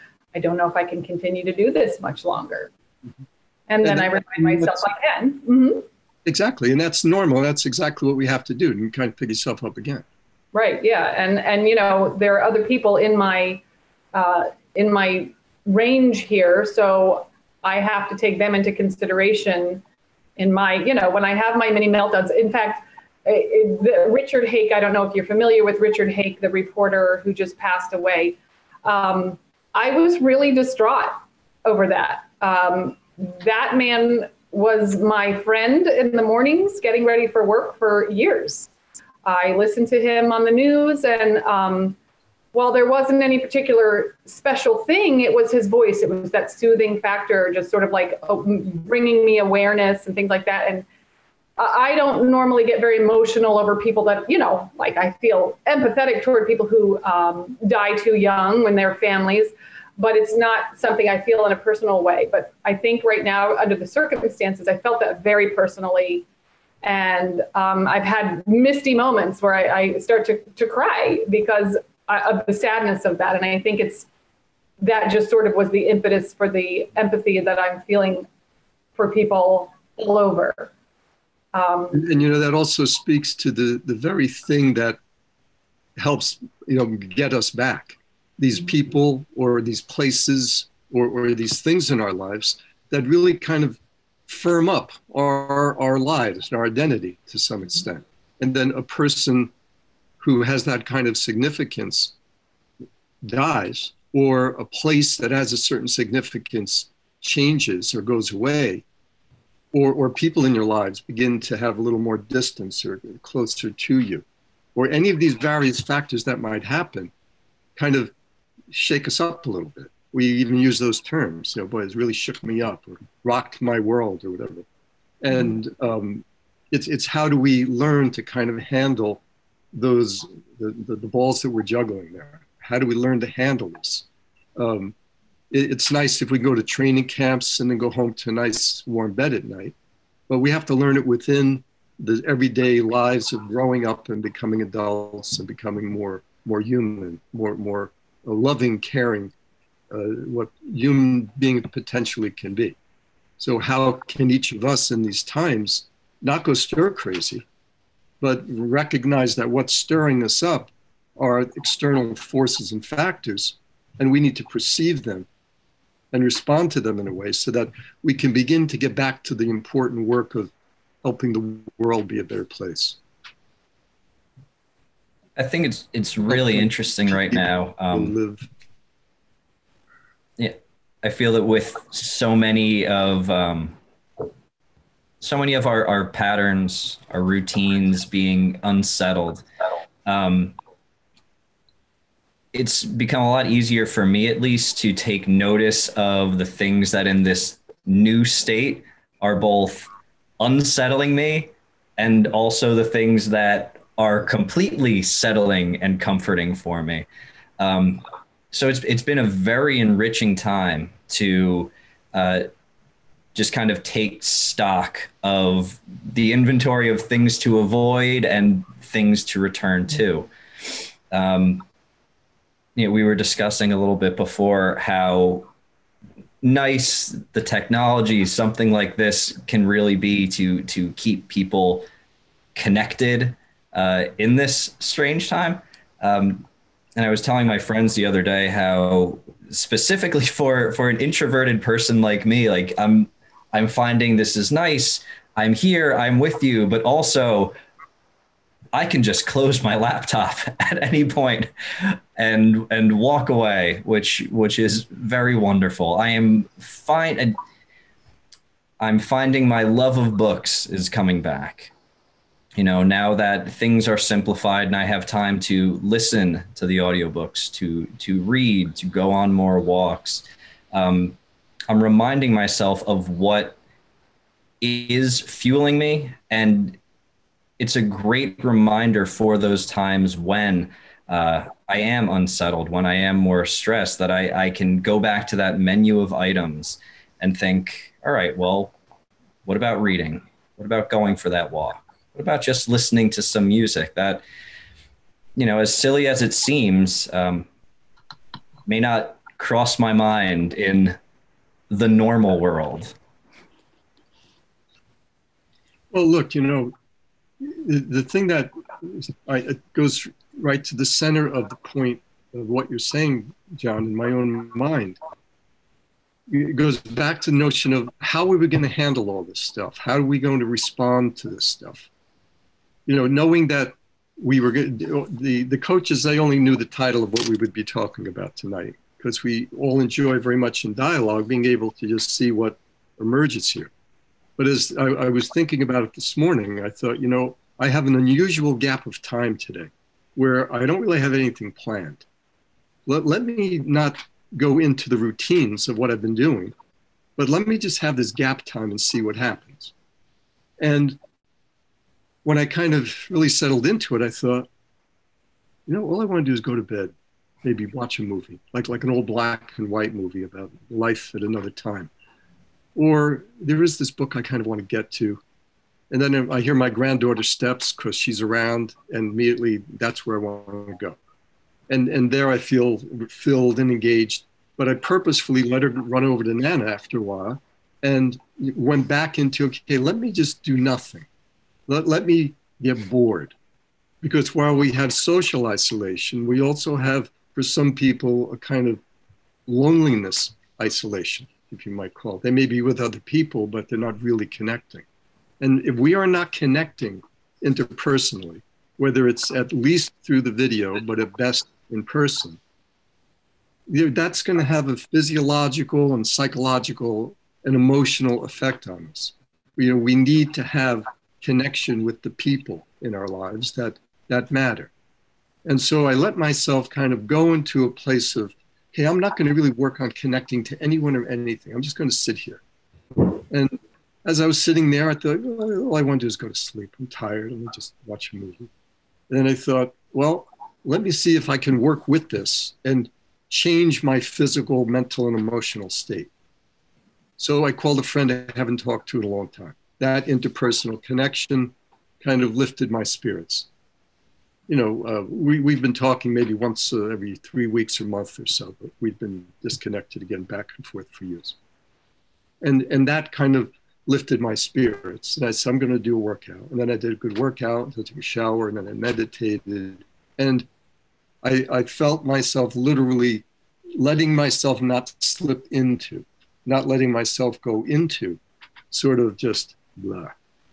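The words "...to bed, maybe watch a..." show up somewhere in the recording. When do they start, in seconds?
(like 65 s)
356 s.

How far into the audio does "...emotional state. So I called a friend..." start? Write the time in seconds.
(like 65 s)
435 s.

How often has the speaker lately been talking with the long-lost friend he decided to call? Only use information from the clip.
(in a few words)
every three weeks.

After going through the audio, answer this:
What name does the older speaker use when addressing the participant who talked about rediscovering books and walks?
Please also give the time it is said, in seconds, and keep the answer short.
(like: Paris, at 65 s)
John, at 313 s.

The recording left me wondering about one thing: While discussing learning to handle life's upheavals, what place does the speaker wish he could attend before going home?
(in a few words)
training camps.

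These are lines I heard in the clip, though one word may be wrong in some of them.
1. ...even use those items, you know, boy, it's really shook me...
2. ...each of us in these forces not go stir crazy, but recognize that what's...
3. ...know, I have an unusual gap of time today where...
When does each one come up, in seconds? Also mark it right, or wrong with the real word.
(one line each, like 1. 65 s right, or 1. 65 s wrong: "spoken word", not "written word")
1. 120 s wrong: "terms", not "items"
2. 154 s wrong: "times", not "forces"
3. 337 s right.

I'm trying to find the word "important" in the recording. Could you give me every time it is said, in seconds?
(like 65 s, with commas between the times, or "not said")
169 s.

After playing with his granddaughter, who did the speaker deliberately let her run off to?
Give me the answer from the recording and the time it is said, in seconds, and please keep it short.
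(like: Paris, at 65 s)
Nana, at 376 s.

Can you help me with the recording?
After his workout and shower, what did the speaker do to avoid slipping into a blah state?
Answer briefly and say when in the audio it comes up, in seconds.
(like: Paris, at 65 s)
meditated, at 458 s.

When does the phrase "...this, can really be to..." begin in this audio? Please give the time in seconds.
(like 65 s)
228 s.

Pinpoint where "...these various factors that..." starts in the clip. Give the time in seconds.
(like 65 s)
115 s.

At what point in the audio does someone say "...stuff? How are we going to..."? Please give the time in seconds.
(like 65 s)
319 s.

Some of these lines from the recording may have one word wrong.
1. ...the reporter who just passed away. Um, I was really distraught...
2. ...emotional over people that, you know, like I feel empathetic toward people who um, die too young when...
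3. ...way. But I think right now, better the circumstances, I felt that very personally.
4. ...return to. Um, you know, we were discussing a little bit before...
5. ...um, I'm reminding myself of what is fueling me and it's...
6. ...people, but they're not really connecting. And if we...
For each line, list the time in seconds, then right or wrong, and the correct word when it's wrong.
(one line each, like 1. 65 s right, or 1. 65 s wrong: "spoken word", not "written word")
1. 26 s right
2. 52 s right
3. 62 s wrong: "under", not "better"
4. 219 s right
5. 270 s right
6. 393 s right.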